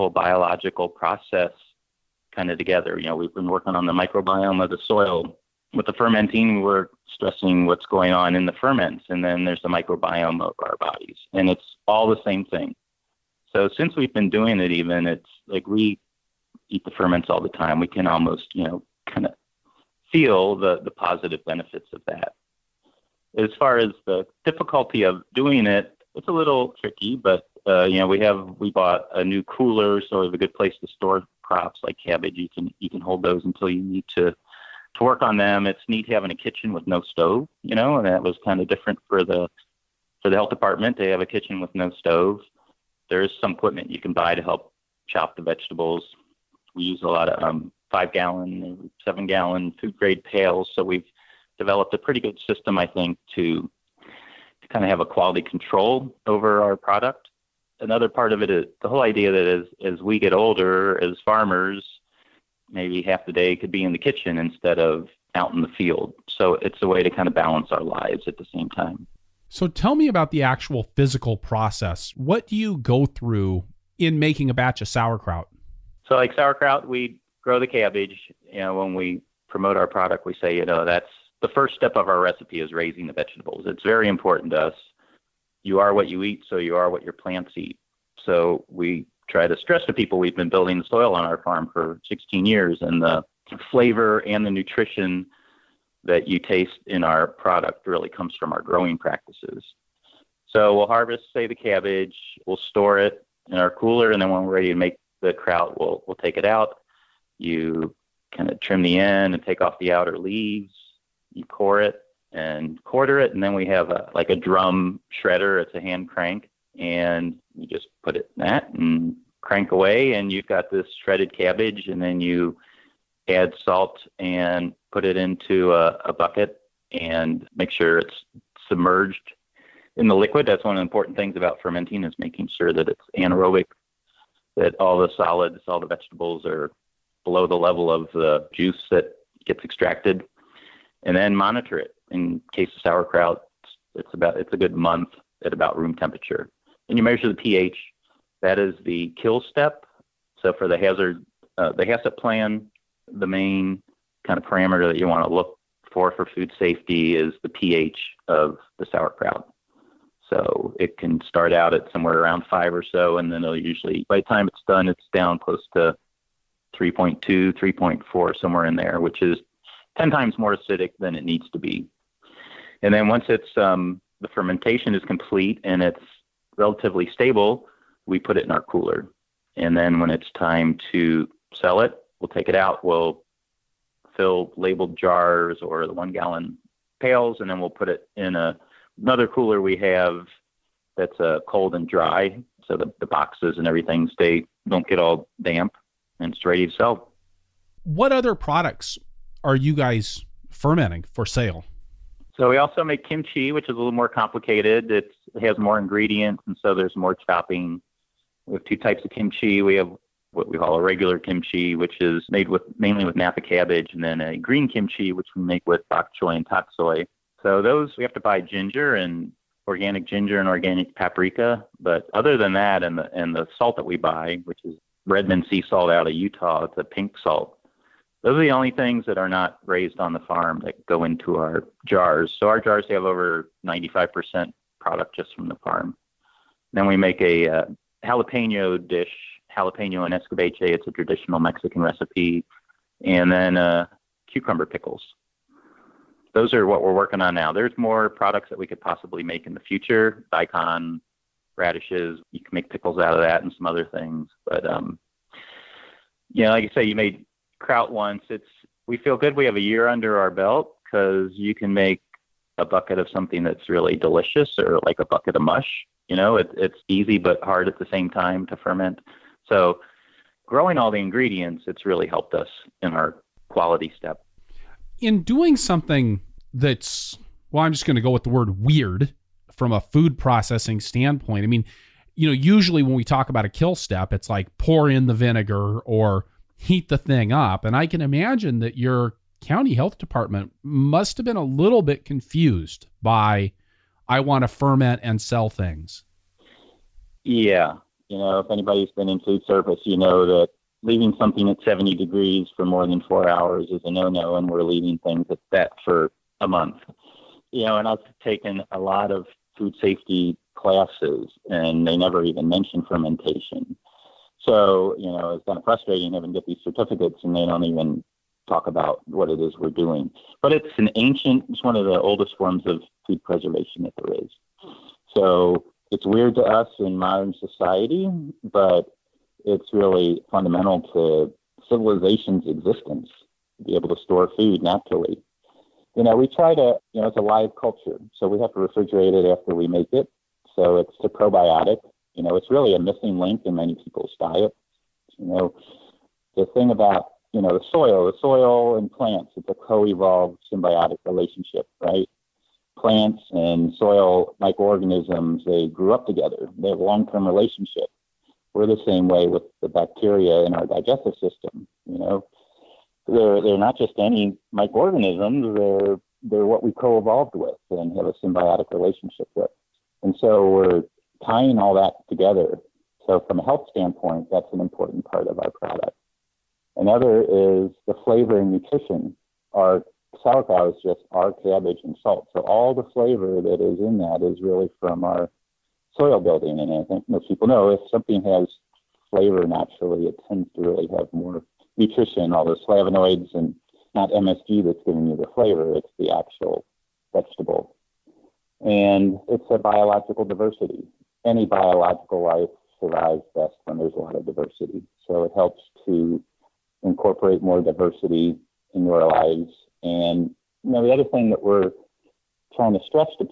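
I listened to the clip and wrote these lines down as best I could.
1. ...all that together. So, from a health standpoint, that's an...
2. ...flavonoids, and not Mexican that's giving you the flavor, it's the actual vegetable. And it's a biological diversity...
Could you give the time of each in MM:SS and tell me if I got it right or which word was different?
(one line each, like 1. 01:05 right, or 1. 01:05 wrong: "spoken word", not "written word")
1. 06:11 right
2. 06:32 wrong: "MSG", not "Mexican".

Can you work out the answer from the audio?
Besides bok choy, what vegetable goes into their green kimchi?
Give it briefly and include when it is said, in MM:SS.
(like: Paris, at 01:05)
tak soy, at 03:36.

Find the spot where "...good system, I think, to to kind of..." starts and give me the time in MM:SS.
00:52.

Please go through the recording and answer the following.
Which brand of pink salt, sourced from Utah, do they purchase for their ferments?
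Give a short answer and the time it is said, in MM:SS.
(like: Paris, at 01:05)
Redmond sea salt, at 03:45.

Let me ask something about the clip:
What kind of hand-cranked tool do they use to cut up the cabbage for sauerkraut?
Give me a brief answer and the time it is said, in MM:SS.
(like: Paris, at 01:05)
drum shredder, at 01:54.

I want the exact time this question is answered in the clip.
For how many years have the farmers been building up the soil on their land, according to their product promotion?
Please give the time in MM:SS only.
01:32.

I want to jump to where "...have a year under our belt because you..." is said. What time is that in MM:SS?
04:19.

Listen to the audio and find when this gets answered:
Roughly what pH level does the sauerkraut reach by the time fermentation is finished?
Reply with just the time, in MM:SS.
02:46.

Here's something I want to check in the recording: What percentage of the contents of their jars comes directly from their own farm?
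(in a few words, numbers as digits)
over 95%.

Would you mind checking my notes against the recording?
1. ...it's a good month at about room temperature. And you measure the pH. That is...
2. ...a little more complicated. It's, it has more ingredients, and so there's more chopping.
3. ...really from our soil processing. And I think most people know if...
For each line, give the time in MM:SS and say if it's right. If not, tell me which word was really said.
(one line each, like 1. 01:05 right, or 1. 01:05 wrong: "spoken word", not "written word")
1. 02:24 right
2. 03:23 right
3. 06:24 wrong: "building", not "processing".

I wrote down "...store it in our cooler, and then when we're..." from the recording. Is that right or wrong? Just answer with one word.
right.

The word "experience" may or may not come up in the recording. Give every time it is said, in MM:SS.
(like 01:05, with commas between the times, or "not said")
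not said.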